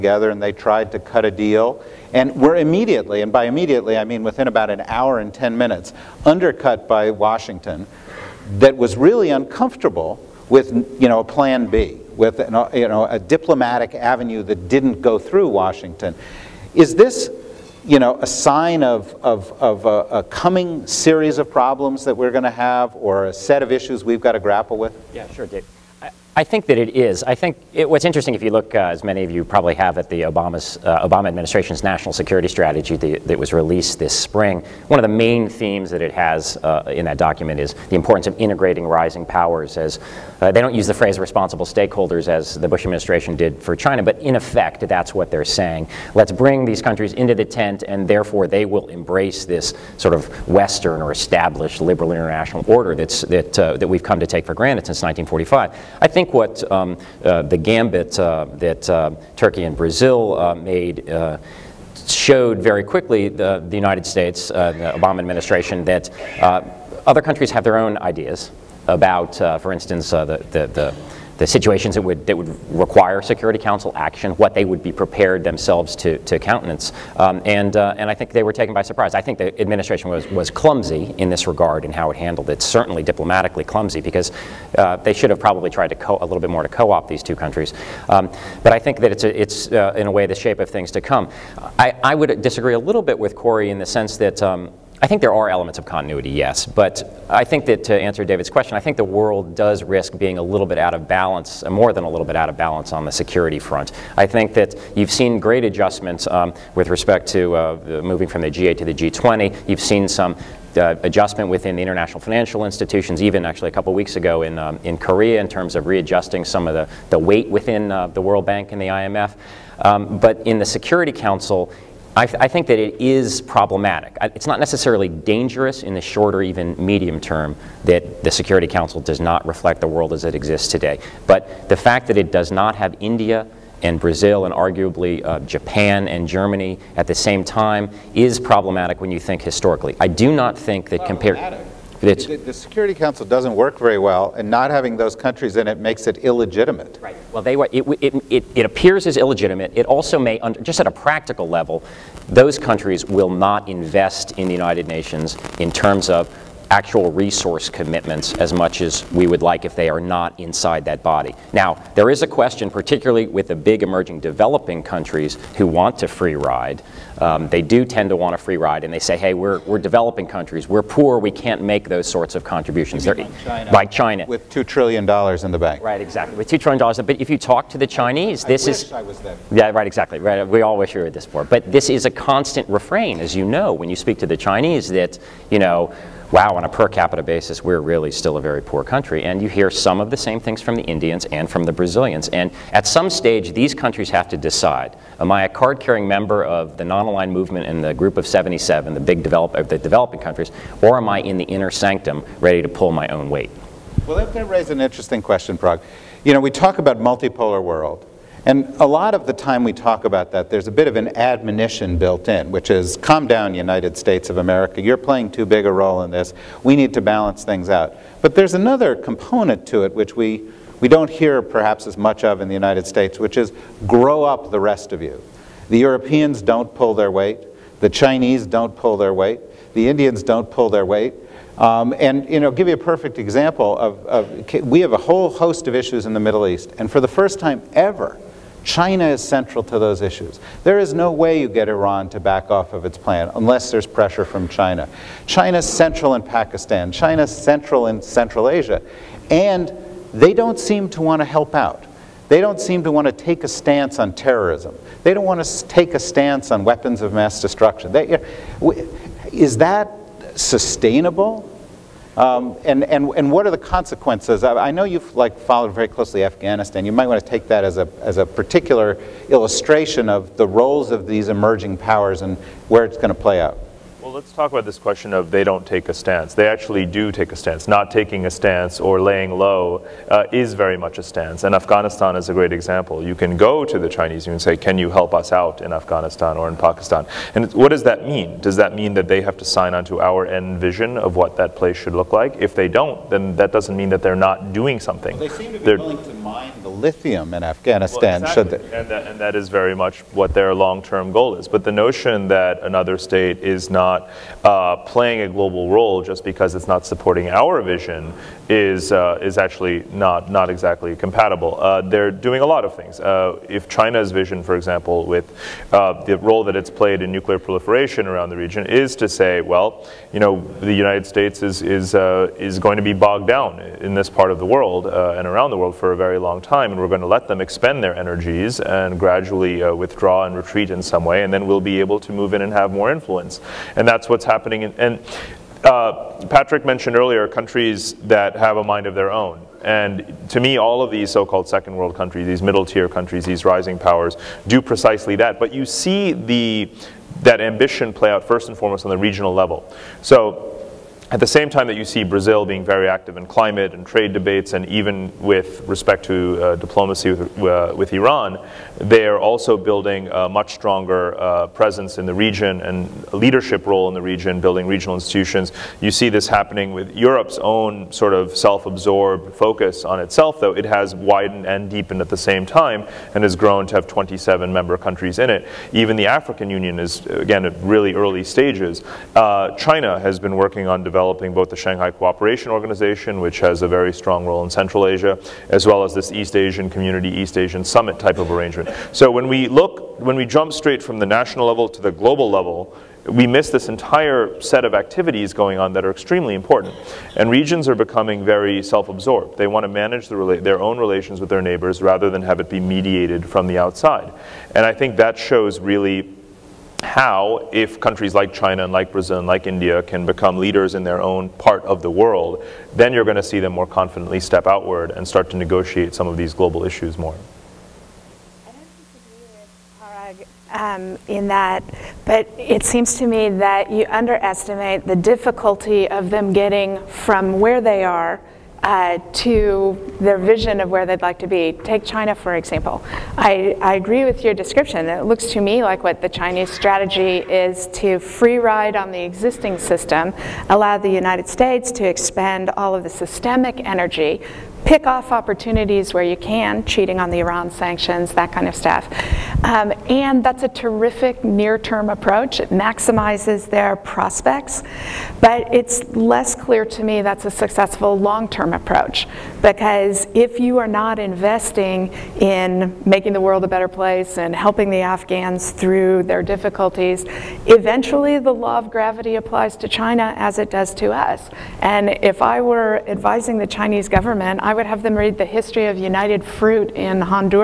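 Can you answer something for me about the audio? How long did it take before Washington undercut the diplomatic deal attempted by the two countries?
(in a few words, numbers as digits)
about an hour and 10 minutes.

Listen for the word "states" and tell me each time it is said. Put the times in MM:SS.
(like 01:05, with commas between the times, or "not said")
01:04, 03:33, 03:42, 05:02, 05:21, 07:21.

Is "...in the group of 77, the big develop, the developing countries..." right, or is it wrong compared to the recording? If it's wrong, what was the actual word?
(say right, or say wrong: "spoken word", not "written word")
right.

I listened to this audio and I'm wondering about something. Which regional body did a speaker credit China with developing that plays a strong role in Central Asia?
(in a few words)
Shanghai Cooperation Organization.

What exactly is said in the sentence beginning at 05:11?
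Uh, they're doing a lot of things.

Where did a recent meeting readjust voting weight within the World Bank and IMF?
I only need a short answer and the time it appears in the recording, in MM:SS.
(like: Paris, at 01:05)
Korea, at 01:54.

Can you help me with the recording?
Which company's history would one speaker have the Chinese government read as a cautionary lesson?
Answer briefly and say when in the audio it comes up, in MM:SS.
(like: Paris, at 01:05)
United Fruit, at 07:55.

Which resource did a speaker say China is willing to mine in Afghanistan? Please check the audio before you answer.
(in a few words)
lithium.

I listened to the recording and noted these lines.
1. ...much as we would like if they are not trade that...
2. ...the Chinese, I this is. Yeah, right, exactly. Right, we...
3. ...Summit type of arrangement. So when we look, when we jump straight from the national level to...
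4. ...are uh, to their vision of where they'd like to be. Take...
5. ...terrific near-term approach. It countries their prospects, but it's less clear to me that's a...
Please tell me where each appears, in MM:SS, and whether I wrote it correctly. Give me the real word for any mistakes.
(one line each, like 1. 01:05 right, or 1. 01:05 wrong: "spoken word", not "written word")
1. 02:38 wrong: "inside", not "trade"
2. 02:57 right
3. 06:27 right
4. 07:07 right
5. 07:30 wrong: "maximizes", not "countries".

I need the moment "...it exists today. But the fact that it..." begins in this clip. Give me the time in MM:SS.
02:10.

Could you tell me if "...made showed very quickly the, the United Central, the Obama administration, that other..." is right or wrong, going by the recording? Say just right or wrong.
wrong.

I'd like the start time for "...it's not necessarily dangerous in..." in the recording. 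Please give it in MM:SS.
02:04.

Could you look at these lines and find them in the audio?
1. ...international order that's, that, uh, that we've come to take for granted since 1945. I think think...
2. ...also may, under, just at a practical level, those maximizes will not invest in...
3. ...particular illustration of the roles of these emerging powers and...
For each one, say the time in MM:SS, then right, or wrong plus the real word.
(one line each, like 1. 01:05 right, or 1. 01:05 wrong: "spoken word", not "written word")
1. 00:52 right
2. 02:29 wrong: "countries", not "maximizes"
3. 04:28 right.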